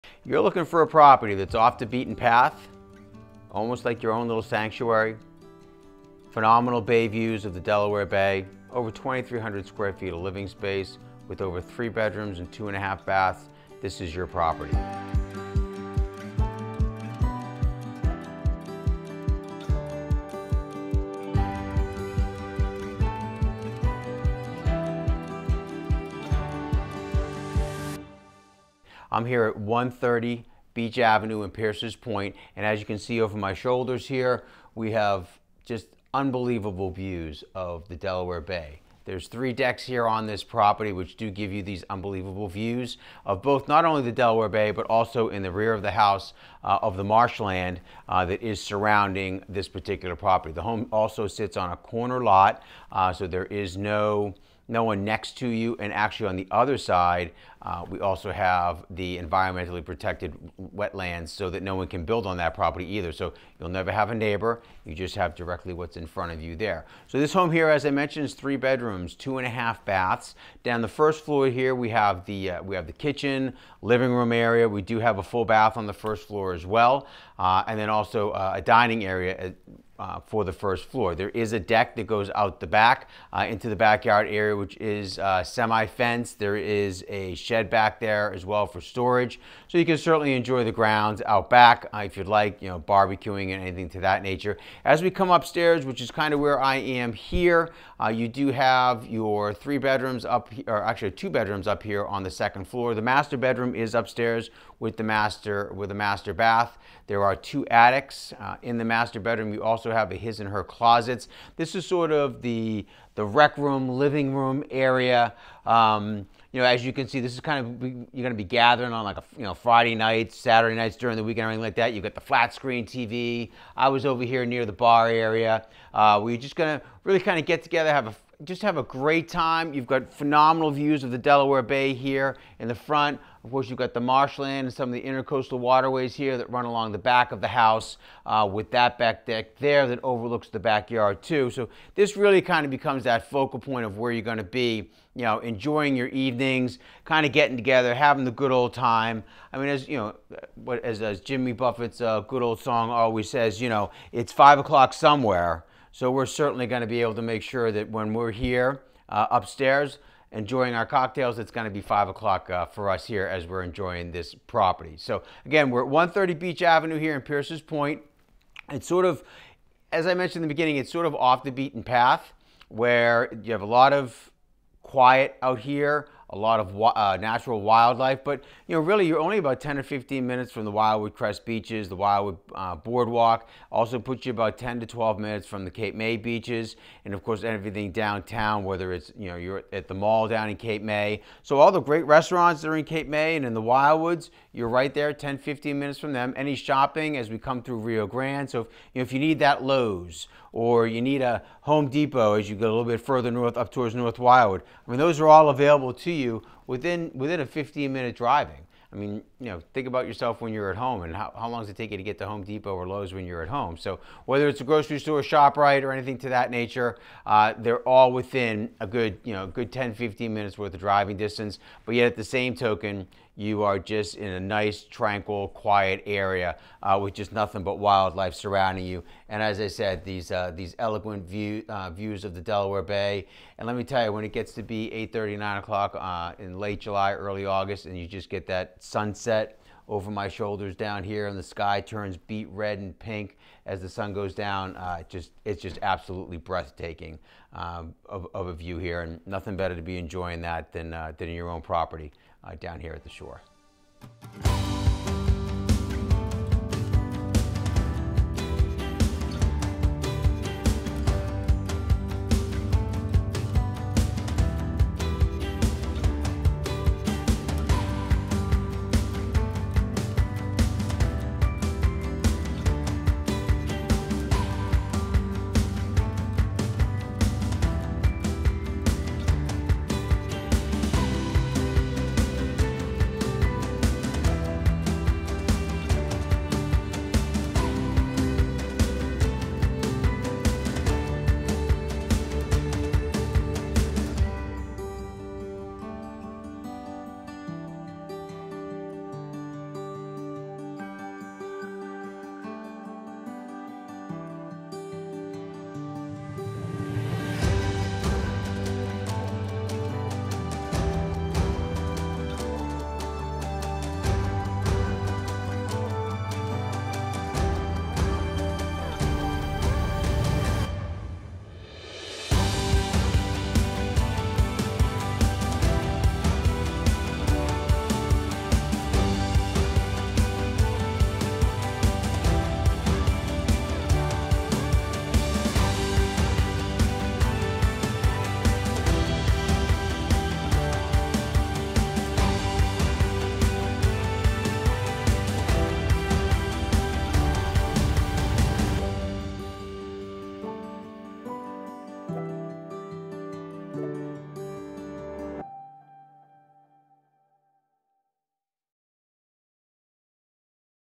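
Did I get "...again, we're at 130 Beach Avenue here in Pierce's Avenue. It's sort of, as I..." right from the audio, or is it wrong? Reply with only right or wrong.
wrong.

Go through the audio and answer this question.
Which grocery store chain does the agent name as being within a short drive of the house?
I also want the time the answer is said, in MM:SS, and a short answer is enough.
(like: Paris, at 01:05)
ShopRite, at 03:35.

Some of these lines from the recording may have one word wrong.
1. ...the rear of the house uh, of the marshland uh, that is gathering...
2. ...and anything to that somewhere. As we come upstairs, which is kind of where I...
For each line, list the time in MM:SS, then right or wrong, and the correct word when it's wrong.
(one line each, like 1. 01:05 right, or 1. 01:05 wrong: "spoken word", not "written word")
1. 00:45 wrong: "surrounding", not "gathering"
2. 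01:33 wrong: "nature", not "somewhere".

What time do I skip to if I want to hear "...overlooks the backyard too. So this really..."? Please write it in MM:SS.
02:20.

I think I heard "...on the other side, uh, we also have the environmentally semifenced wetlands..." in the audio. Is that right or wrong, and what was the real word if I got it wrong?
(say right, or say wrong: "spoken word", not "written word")
wrong: "protected", not "semifenced".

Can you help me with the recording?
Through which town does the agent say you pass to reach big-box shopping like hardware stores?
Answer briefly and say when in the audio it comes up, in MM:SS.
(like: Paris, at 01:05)
Rio Grande, at 03:17.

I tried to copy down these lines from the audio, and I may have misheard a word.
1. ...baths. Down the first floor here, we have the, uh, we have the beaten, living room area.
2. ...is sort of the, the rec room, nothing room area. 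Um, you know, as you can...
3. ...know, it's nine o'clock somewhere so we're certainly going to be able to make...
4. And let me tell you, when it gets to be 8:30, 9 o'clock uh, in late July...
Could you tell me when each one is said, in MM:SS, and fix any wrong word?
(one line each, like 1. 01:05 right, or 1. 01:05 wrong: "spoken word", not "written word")
1. 01:09 wrong: "kitchen", not "beaten"
2. 01:51 wrong: "living", not "nothing"
3. 02:33 wrong: "five", not "nine"
4. 03:53 right.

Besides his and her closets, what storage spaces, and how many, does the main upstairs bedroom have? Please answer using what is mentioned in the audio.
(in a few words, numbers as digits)
two attics.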